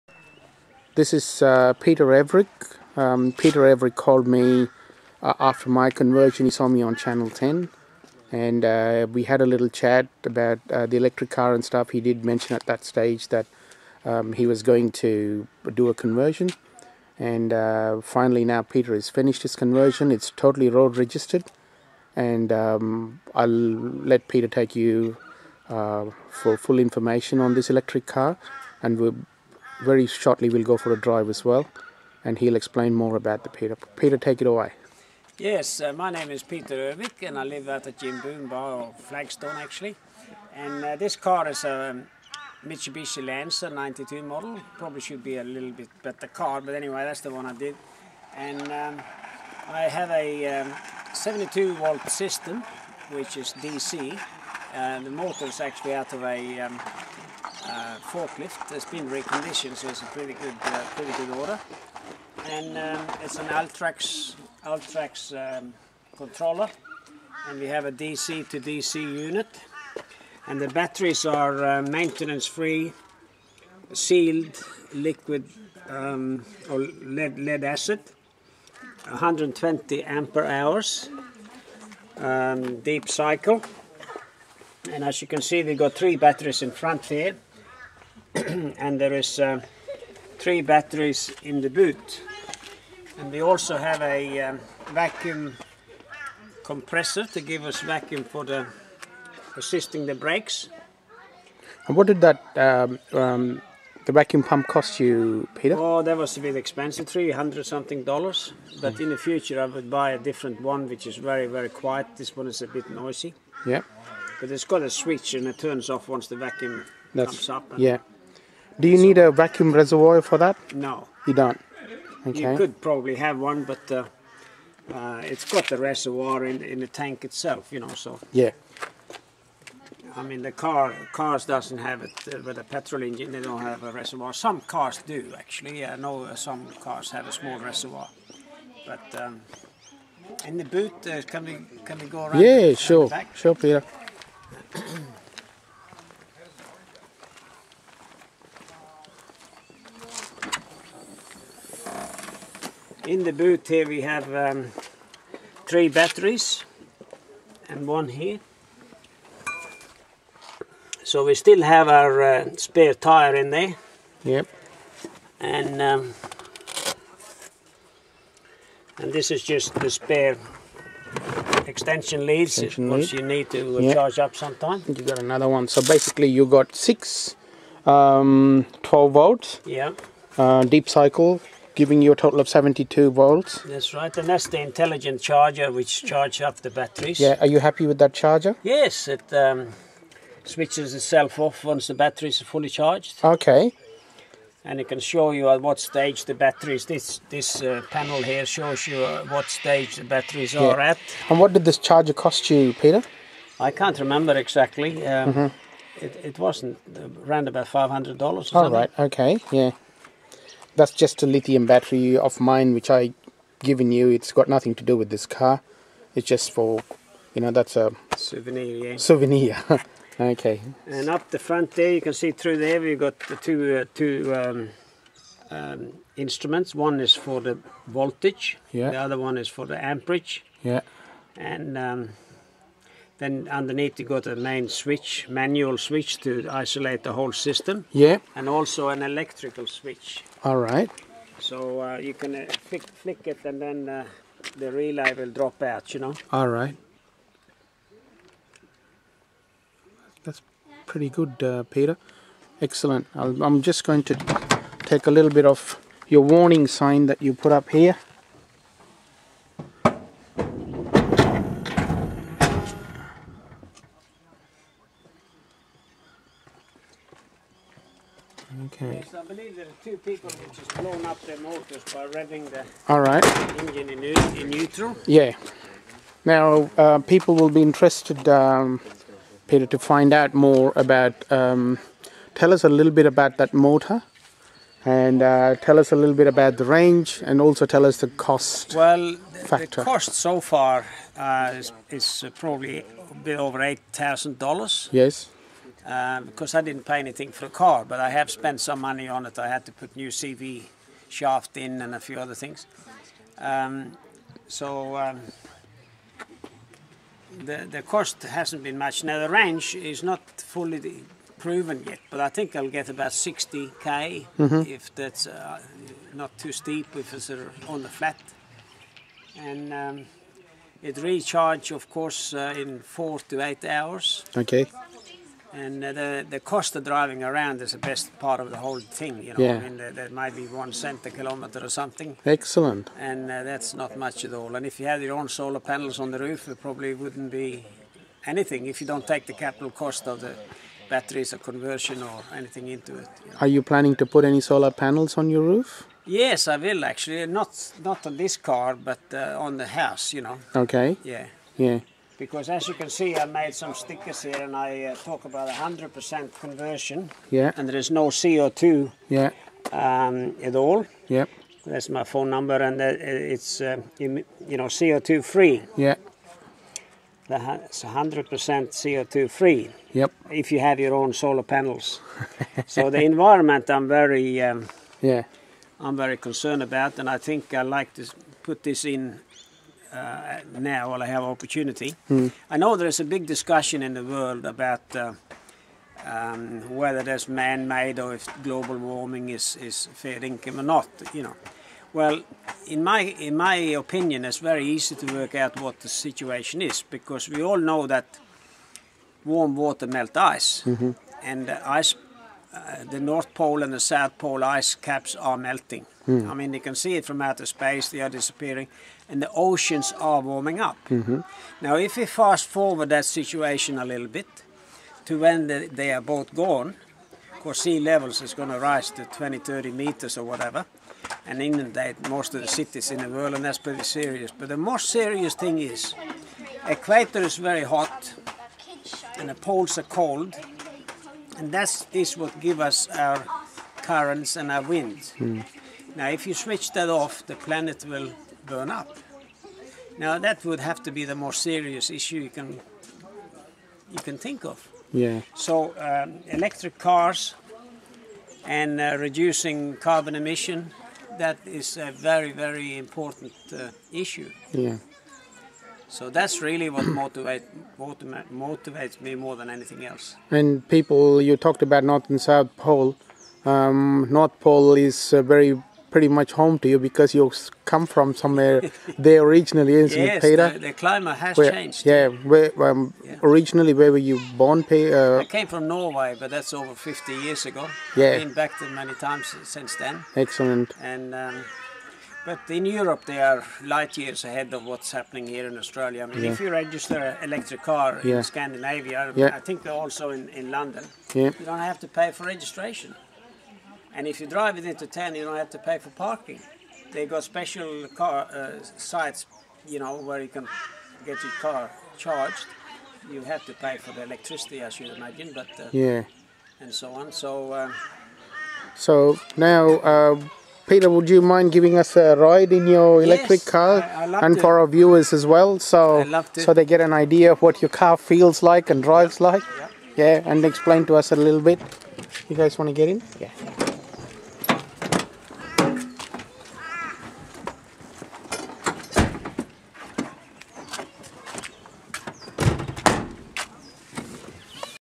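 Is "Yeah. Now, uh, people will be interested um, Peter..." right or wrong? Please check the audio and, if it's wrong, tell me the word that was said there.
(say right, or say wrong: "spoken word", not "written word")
right.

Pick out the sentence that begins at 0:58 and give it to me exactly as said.
It's been reconditioned, so it's a pretty good, uh, pretty good order.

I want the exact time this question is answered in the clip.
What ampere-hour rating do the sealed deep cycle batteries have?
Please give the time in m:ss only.
1:19.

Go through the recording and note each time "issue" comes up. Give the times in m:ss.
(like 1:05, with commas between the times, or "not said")
7:21, 7:34.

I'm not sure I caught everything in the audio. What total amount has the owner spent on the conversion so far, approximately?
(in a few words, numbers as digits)
Over $8,000.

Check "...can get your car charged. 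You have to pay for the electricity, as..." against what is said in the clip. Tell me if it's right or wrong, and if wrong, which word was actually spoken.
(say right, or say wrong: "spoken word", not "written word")
right.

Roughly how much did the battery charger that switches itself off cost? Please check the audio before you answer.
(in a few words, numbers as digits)
$500.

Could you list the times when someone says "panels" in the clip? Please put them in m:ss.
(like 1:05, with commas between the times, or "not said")
3:17, 5:35, 5:44, 6:11.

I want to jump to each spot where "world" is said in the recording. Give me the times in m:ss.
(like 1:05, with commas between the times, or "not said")
6:24, 7:03.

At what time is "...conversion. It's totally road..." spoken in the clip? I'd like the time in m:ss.
0:19.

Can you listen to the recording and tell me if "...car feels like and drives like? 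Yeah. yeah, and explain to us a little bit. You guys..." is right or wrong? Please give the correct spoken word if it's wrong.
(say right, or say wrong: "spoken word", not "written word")
right.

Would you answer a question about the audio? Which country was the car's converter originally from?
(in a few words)
Norway.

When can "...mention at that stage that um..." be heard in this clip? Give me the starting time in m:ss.
0:12.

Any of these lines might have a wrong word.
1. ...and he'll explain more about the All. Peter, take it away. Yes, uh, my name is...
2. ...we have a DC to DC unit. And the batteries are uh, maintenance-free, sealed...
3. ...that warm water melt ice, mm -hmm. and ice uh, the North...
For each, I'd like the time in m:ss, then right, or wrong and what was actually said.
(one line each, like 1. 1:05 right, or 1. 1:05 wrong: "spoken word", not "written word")
1. 0:32 wrong: "Peter", not "All"
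2. 1:07 right
3. 6:37 right.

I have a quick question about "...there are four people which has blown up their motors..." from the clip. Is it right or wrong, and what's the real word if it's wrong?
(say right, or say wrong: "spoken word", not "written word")
wrong: "two", not "four".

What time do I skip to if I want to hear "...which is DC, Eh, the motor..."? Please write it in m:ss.
0:53.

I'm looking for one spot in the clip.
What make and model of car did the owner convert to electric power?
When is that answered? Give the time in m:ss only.
0:42.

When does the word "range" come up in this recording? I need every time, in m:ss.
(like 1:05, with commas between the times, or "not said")
4:46, 5:09.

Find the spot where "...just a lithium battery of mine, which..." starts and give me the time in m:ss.
3:31.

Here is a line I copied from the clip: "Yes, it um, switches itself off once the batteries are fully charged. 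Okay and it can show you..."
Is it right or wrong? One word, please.
right.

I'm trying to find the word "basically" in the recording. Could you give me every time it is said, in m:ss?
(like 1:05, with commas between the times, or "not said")
2:55.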